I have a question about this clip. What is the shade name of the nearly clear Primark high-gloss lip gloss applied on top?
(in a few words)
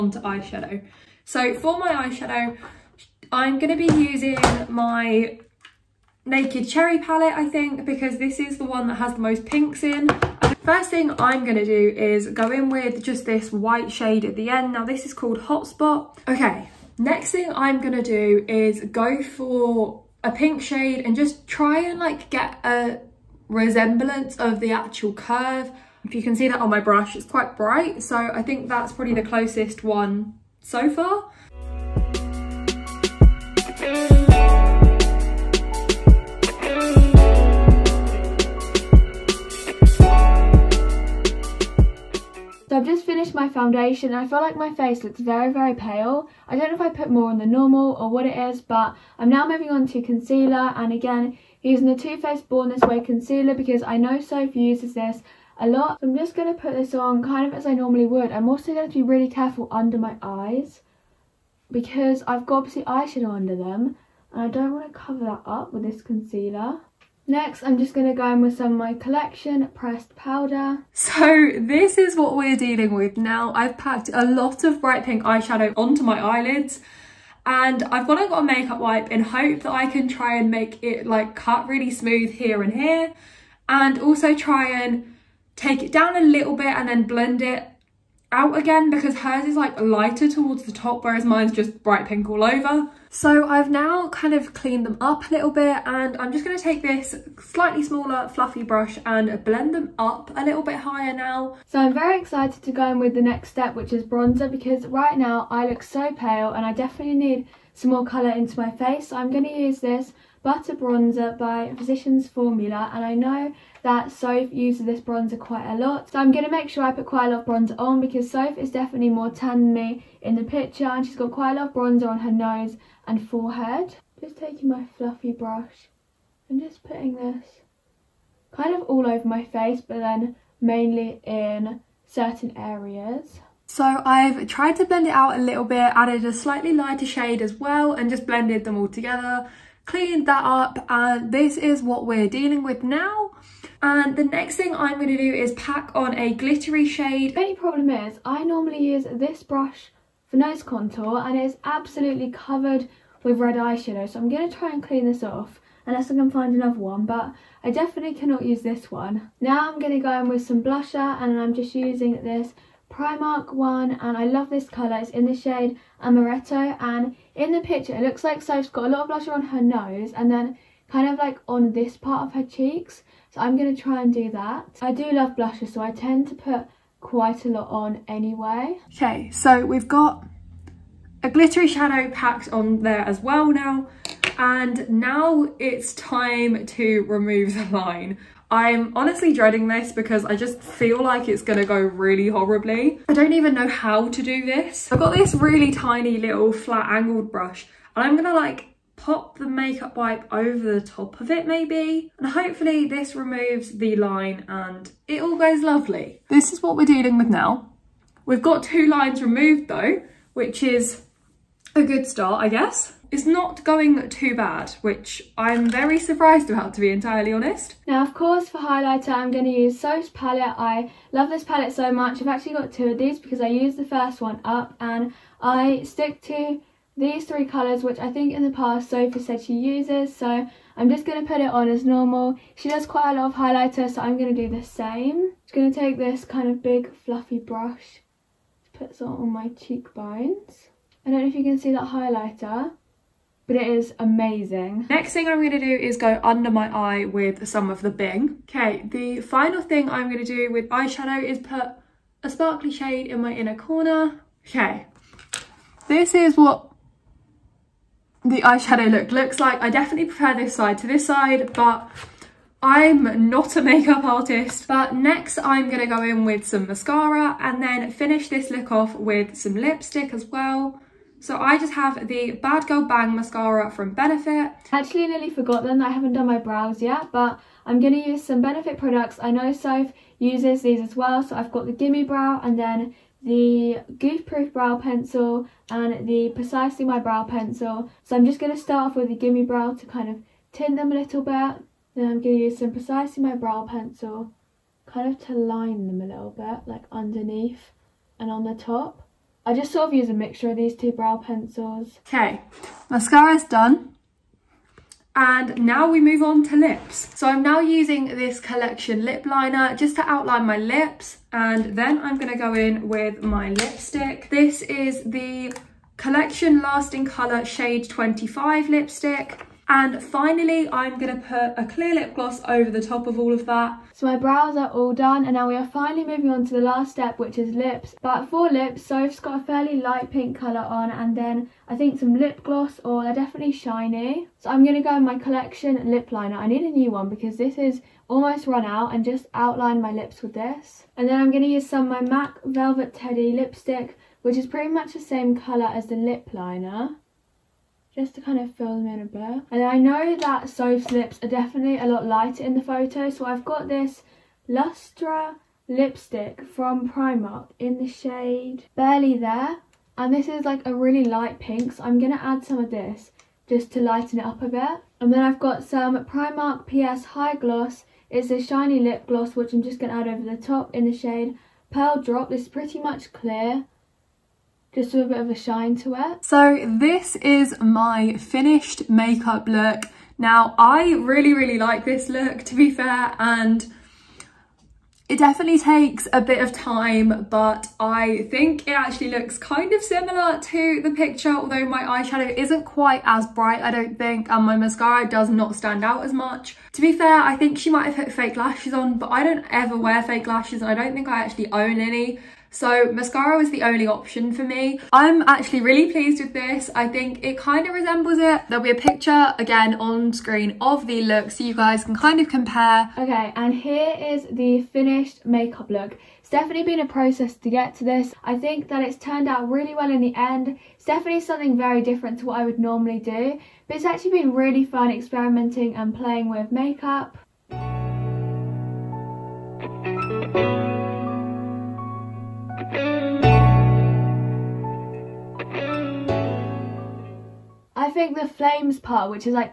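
Pearl Drop.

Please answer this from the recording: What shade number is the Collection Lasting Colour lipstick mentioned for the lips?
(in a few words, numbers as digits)
25.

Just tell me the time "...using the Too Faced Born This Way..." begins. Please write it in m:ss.
0:51.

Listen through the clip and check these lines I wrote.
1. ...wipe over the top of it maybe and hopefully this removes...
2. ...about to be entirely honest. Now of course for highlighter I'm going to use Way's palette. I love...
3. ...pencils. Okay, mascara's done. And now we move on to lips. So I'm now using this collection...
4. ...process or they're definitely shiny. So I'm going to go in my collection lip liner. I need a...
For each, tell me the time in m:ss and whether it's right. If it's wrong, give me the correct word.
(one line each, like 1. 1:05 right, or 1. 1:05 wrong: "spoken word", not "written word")
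1. 3:19 right
2. 3:36 wrong: "Soph", not "Way"
3. 5:01 right
4. 5:32 wrong: "gloss", not "process".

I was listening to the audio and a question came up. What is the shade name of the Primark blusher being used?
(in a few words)
Amaretto.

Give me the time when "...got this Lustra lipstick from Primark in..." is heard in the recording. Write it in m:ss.
5:53.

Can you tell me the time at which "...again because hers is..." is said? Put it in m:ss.
1:28.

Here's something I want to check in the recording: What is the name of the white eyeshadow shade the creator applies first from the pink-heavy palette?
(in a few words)
Hotspot.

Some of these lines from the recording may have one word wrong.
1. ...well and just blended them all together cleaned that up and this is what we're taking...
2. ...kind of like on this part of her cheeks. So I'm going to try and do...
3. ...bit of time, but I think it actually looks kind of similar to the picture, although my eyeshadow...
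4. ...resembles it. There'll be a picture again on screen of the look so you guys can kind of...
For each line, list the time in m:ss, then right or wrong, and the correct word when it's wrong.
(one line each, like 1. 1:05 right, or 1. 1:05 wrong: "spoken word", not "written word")
1. 2:17 wrong: "dealing", not "taking"
2. 2:50 right
3. 6:26 right
4. 6:47 right.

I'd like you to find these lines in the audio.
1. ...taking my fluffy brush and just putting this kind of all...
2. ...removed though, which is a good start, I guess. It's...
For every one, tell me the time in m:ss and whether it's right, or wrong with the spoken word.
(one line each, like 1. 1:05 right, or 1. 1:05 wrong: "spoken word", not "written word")
1. 2:04 right
2. 3:29 right.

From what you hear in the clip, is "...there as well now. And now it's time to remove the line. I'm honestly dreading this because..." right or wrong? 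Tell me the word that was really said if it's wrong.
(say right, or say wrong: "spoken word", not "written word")
right.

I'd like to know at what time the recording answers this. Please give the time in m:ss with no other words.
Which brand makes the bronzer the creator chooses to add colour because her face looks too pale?
1:51.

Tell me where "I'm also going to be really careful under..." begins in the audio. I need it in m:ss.
0:58.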